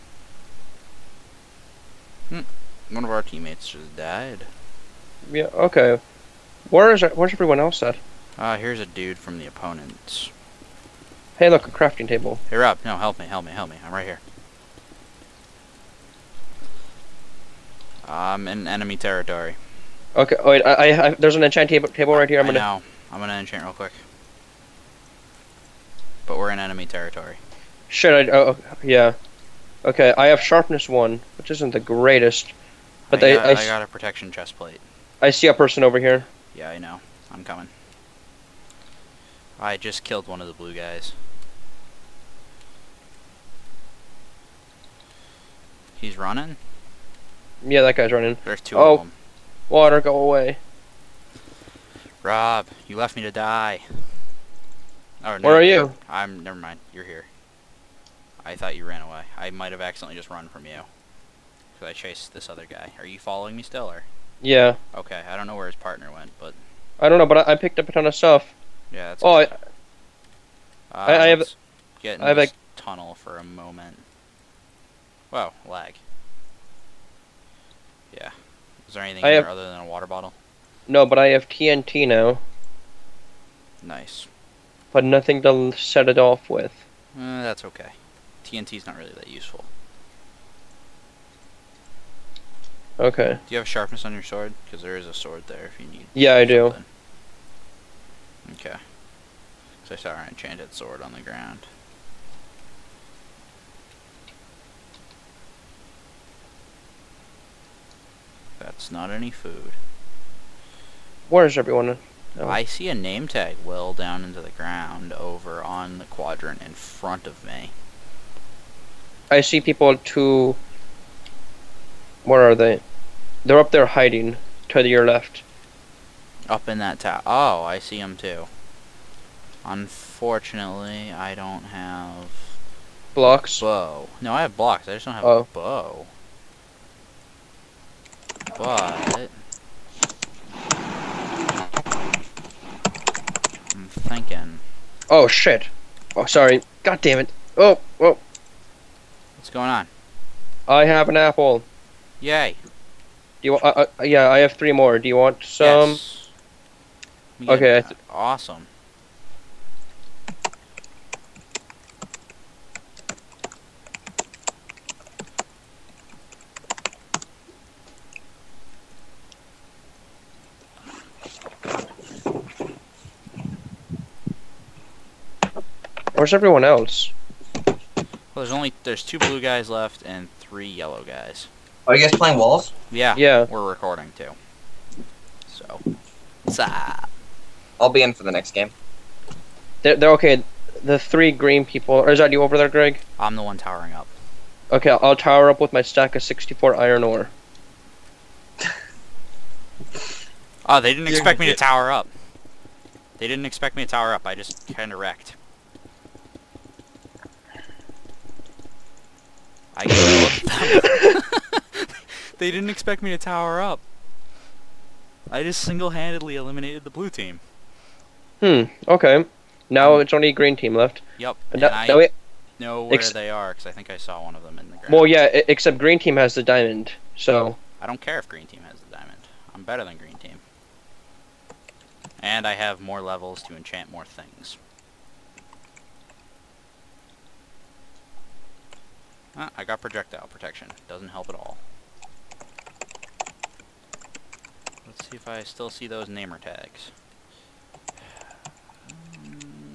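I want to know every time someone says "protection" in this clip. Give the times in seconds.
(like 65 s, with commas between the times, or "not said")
33 s, 240 s.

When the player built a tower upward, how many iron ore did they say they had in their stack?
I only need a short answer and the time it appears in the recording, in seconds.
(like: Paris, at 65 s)
64, at 196 s.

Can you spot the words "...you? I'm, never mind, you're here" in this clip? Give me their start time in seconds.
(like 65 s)
55 s.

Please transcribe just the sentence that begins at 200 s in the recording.
oh, they didn't expect me to tower up.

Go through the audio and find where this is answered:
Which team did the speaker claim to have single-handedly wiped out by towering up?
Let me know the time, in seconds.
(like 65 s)
216 s.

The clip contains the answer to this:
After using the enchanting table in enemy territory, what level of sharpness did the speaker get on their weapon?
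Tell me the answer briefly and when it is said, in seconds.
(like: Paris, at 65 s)
Sharpness 1, at 30 s.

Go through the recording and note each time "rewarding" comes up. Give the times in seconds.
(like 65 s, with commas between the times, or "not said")
not said.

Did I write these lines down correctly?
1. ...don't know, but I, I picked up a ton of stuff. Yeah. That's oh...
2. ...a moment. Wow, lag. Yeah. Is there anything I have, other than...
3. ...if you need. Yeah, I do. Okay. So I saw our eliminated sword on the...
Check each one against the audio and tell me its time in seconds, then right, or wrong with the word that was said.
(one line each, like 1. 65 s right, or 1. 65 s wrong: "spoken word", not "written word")
1. 67 s right
2. 73 s right
3. 95 s wrong: "enchanted", not "eliminated".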